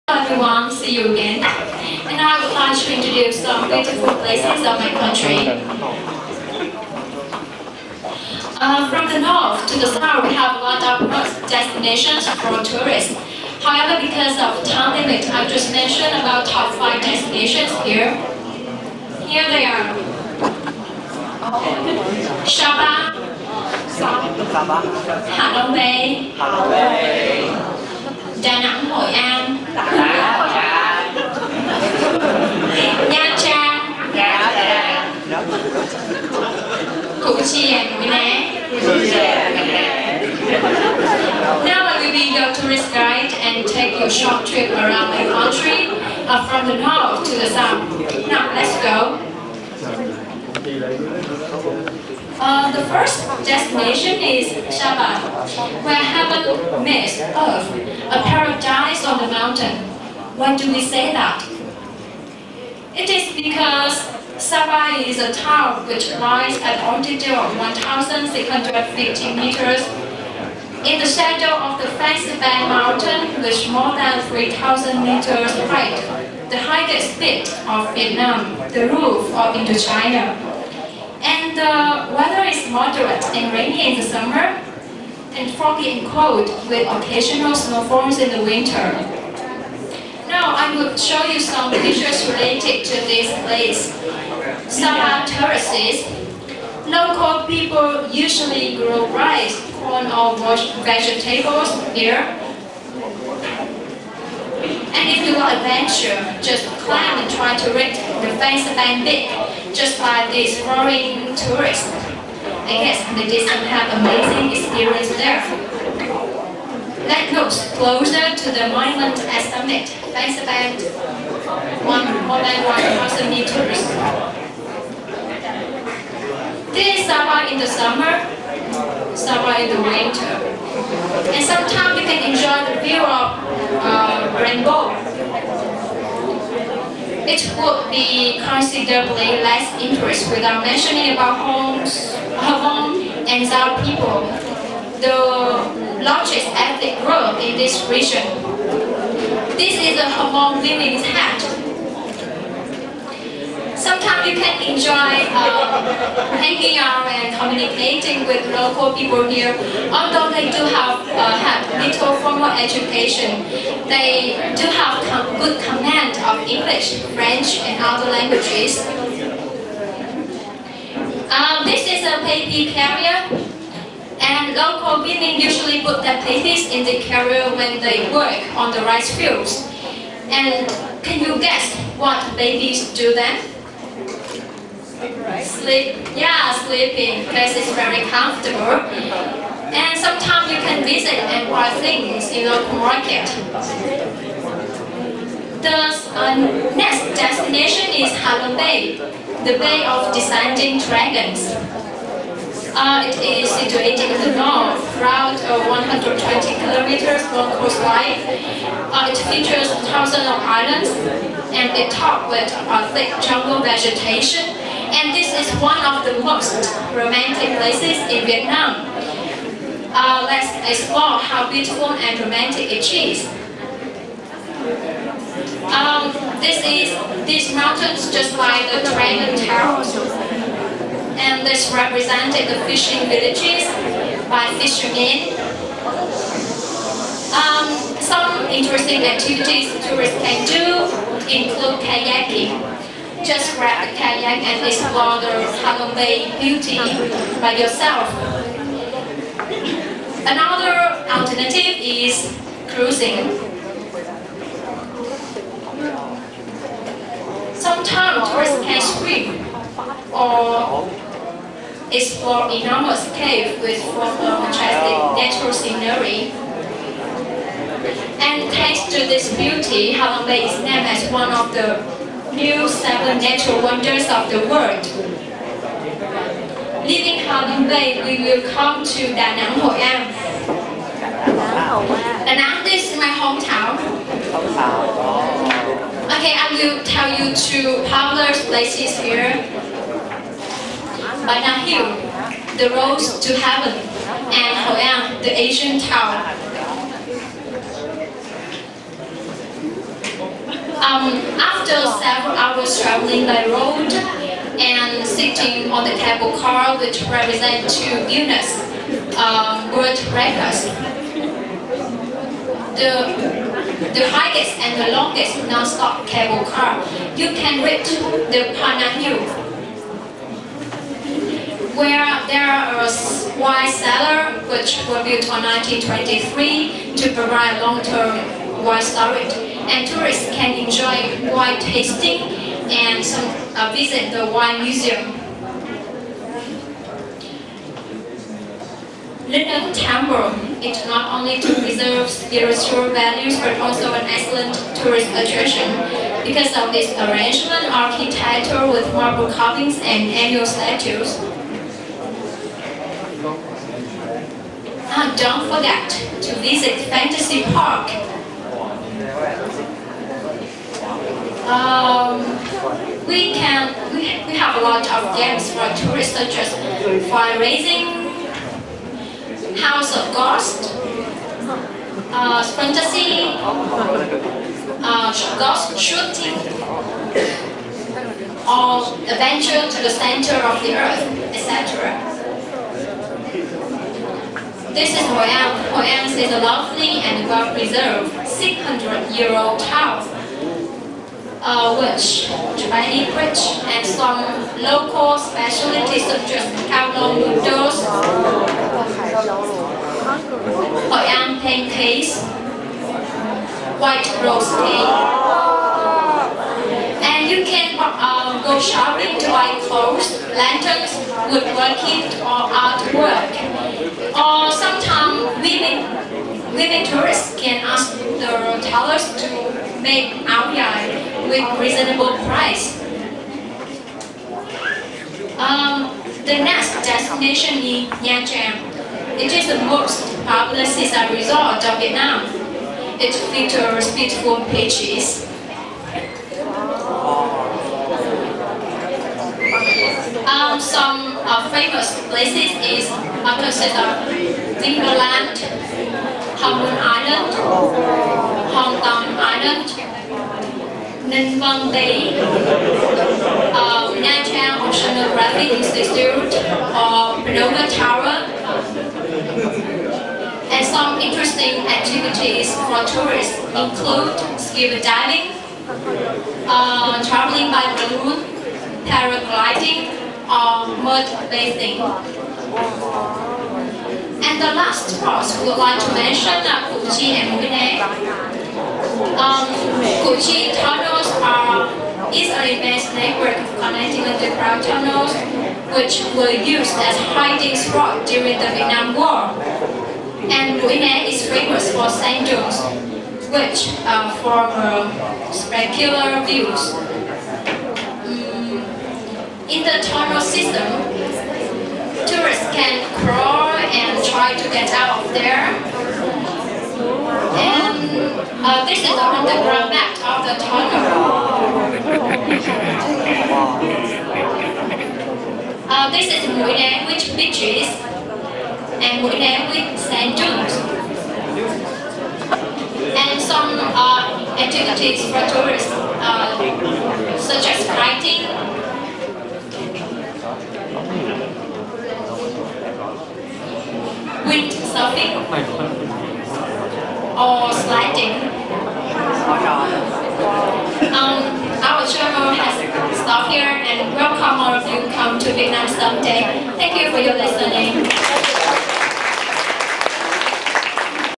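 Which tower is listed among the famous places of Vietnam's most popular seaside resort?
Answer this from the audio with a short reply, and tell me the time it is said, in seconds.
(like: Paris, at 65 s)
Ponagar Tower, at 457 s.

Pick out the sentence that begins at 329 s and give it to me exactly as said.
And tourists can enjoy wine tasting and some, uh, visit the wine museum.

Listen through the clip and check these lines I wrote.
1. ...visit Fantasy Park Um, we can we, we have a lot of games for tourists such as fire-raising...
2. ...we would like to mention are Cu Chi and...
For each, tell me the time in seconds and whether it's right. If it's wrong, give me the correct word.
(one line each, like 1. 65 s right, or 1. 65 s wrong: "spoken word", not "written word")
1. 356 s right
2. 475 s right.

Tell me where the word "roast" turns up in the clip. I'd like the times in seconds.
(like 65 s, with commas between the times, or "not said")
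404 s.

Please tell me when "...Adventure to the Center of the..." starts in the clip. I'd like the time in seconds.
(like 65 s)
379 s.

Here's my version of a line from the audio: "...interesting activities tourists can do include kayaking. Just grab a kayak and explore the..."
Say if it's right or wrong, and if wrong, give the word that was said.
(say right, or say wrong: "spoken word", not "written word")
right.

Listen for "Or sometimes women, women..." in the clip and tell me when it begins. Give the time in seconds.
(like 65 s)
414 s.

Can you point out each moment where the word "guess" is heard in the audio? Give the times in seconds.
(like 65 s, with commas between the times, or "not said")
112 s, 181 s.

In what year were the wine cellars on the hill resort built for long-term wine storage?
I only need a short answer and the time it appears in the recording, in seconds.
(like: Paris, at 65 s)
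1923, at 325 s.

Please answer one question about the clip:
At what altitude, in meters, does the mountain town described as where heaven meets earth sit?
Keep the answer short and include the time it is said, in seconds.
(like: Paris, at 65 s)
1,650 meters, at 67 s.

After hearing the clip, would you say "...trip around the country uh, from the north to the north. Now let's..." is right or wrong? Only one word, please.
wrong.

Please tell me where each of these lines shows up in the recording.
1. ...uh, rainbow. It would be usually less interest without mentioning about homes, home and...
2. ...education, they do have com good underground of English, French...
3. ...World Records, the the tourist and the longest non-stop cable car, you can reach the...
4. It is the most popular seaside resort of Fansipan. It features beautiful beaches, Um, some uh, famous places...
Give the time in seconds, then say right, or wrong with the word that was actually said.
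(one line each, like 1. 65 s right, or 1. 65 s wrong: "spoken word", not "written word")
1. 133 s wrong: "considerably", not "usually"
2. 162 s wrong: "command", not "underground"
3. 309 s wrong: "highest", not "tourist"
4. 429 s wrong: "Vietnam", not "Fansipan".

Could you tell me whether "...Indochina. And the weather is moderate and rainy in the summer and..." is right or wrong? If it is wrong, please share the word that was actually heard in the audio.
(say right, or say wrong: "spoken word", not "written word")
right.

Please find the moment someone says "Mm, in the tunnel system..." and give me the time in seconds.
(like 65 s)
498 s.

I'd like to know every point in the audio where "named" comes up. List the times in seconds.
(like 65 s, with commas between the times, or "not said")
270 s.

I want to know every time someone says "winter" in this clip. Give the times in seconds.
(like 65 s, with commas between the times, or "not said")
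88 s, 129 s.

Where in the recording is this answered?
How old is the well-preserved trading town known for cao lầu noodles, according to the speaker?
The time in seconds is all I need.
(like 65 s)
388 s.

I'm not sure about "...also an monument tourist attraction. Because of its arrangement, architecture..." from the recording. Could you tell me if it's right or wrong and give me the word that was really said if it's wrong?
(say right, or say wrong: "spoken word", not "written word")
wrong: "excellent", not "monument".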